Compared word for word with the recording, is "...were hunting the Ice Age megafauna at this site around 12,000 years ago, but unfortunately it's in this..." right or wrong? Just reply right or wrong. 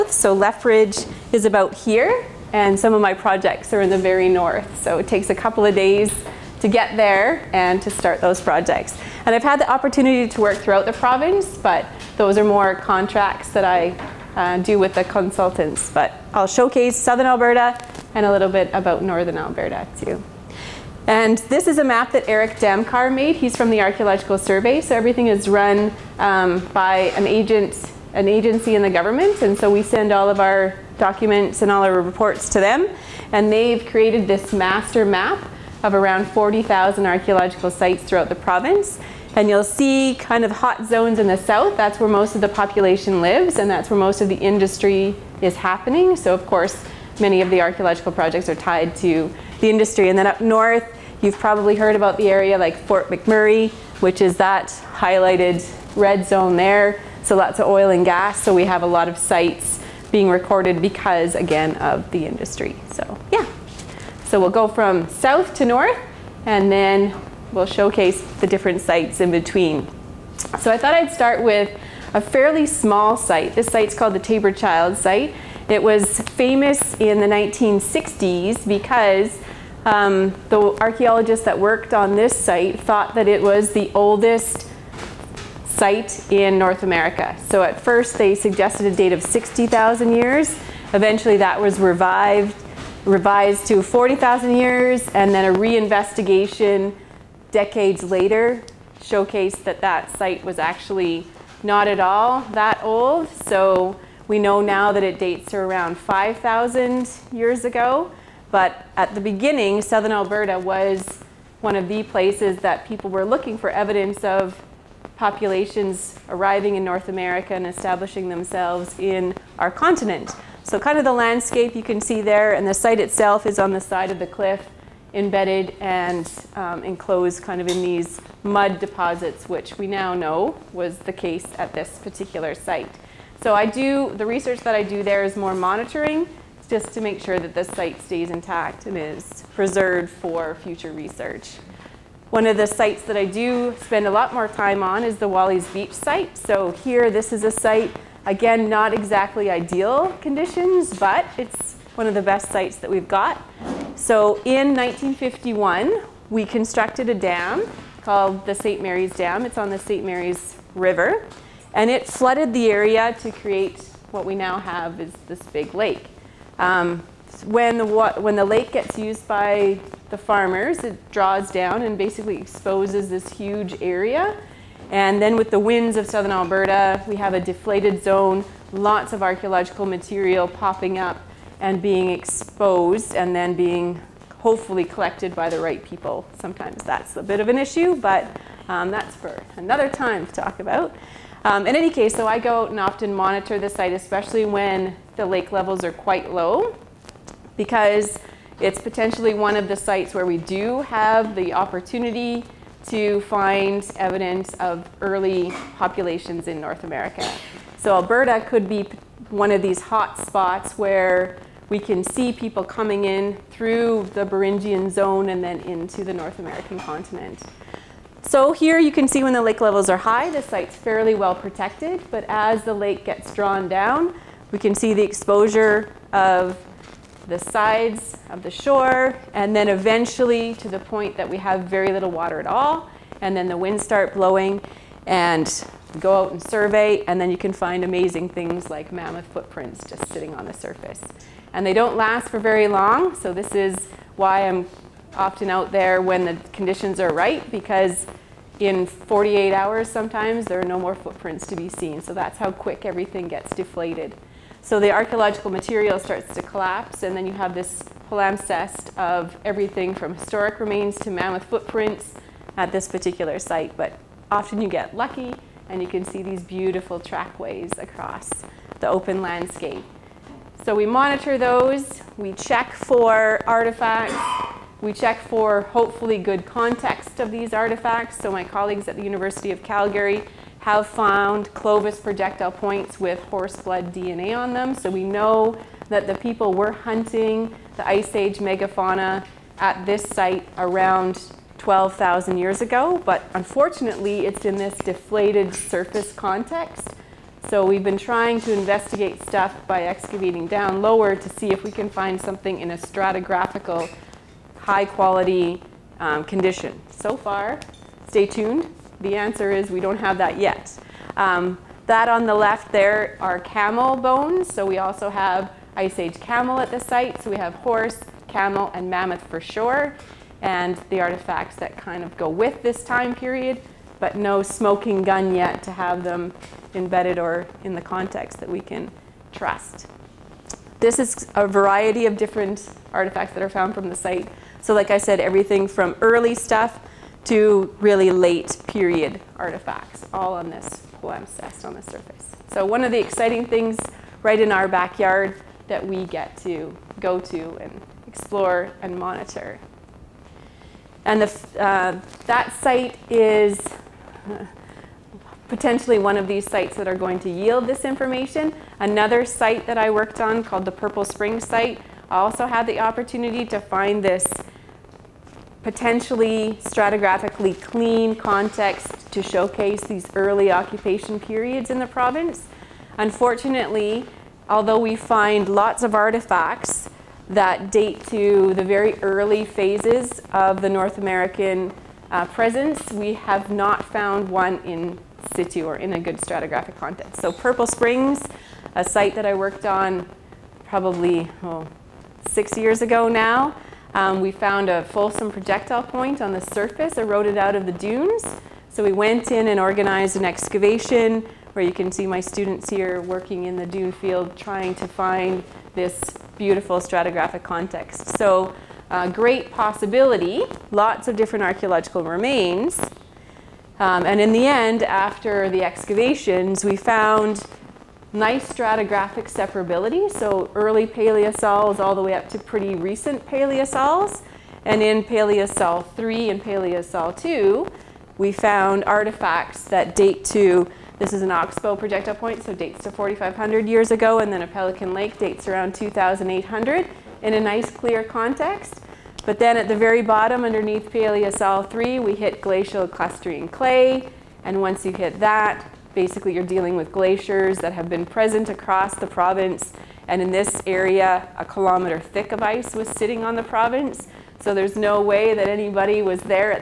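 right.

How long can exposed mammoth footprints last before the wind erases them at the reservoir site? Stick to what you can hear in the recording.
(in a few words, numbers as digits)
48 hours.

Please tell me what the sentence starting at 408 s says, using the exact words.
So uh, great possibility, lots of different archaeological remains.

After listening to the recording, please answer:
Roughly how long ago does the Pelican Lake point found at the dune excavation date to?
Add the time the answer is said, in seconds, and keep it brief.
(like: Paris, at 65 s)
2,800 years, at 434 s.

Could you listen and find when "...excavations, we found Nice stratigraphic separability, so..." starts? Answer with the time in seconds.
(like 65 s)
415 s.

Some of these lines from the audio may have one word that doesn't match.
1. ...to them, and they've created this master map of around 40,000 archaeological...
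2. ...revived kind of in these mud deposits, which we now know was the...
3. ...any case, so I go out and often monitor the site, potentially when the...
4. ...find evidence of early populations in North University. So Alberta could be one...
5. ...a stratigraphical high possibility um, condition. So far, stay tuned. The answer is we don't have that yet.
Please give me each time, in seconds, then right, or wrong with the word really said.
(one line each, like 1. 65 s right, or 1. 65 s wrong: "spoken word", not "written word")
1. 32 s right
2. 126 s wrong: "enclosed", not "revived"
3. 191 s wrong: "especially", not "potentially"
4. 203 s wrong: "America", not "University"
5. 302 s wrong: "quality", not "possibility".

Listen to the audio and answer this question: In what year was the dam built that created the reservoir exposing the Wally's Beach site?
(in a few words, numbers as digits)
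1951.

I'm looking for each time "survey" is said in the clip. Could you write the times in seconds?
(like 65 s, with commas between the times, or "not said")
24 s, 236 s.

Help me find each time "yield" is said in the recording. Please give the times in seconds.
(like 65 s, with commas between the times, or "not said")
357 s.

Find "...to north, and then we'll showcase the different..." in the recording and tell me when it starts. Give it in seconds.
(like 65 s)
65 s.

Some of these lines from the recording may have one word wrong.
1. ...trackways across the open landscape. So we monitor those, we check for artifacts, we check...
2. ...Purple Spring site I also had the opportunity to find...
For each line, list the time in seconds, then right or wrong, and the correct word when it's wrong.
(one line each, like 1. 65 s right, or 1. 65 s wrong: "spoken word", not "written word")
1. 266 s right
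2. 360 s right.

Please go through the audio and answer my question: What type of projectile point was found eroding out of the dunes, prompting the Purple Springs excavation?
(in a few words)
Folsom.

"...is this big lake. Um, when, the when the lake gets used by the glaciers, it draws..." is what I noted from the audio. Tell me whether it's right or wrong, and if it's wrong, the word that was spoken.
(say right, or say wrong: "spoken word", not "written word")
wrong: "farmers", not "glaciers".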